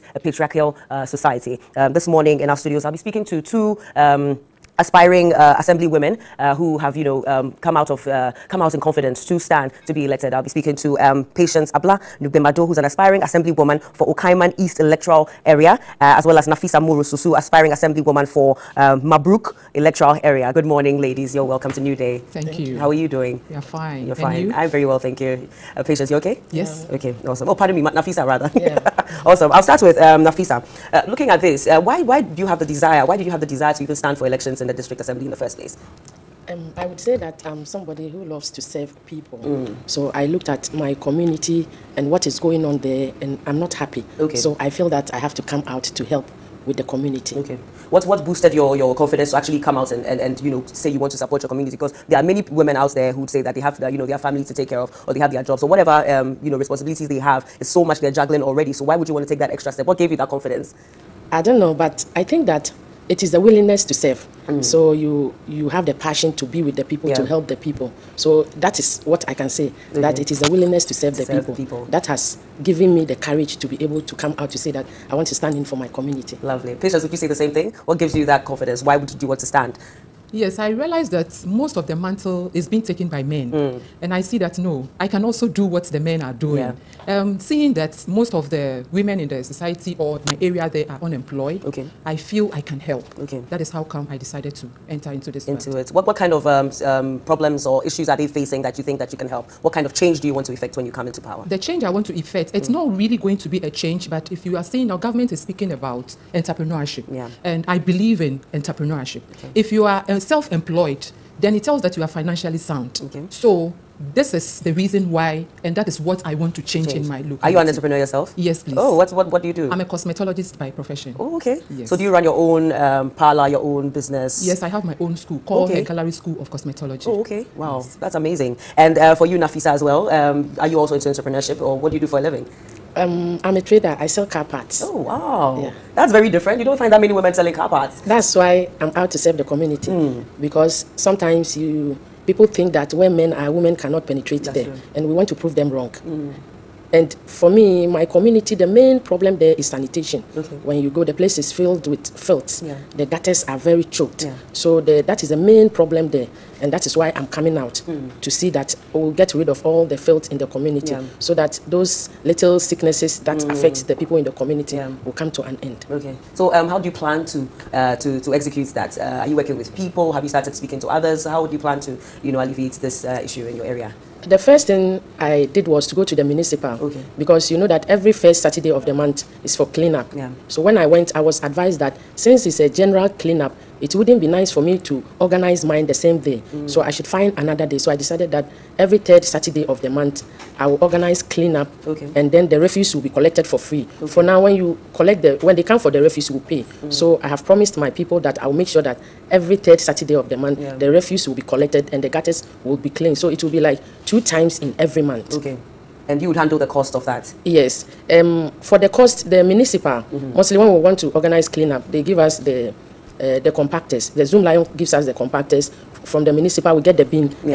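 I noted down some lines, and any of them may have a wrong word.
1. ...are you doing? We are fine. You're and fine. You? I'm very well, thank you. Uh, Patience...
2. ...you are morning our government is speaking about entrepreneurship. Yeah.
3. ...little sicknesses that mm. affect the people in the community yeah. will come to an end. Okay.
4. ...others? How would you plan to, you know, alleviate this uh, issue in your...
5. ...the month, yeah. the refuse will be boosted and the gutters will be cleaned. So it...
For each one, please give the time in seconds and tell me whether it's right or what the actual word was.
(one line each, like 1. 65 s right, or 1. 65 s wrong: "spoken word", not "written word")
1. 22 s right
2. 104 s wrong: "seeing", not "morning"
3. 162 s right
4. 170 s right
5. 200 s wrong: "collected", not "boosted".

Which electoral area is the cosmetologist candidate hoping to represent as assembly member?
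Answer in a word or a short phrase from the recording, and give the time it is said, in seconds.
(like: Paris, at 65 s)
Okaiman East, at 14 s.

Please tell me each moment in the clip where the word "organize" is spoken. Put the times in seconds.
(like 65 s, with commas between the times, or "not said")
185 s, 190 s, 211 s.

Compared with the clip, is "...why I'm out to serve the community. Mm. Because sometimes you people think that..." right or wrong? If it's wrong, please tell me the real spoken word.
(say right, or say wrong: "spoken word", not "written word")
right.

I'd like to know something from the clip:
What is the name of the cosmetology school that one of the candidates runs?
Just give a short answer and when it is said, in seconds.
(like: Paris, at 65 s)
Head Gallery School of Cosmetology, at 125 s.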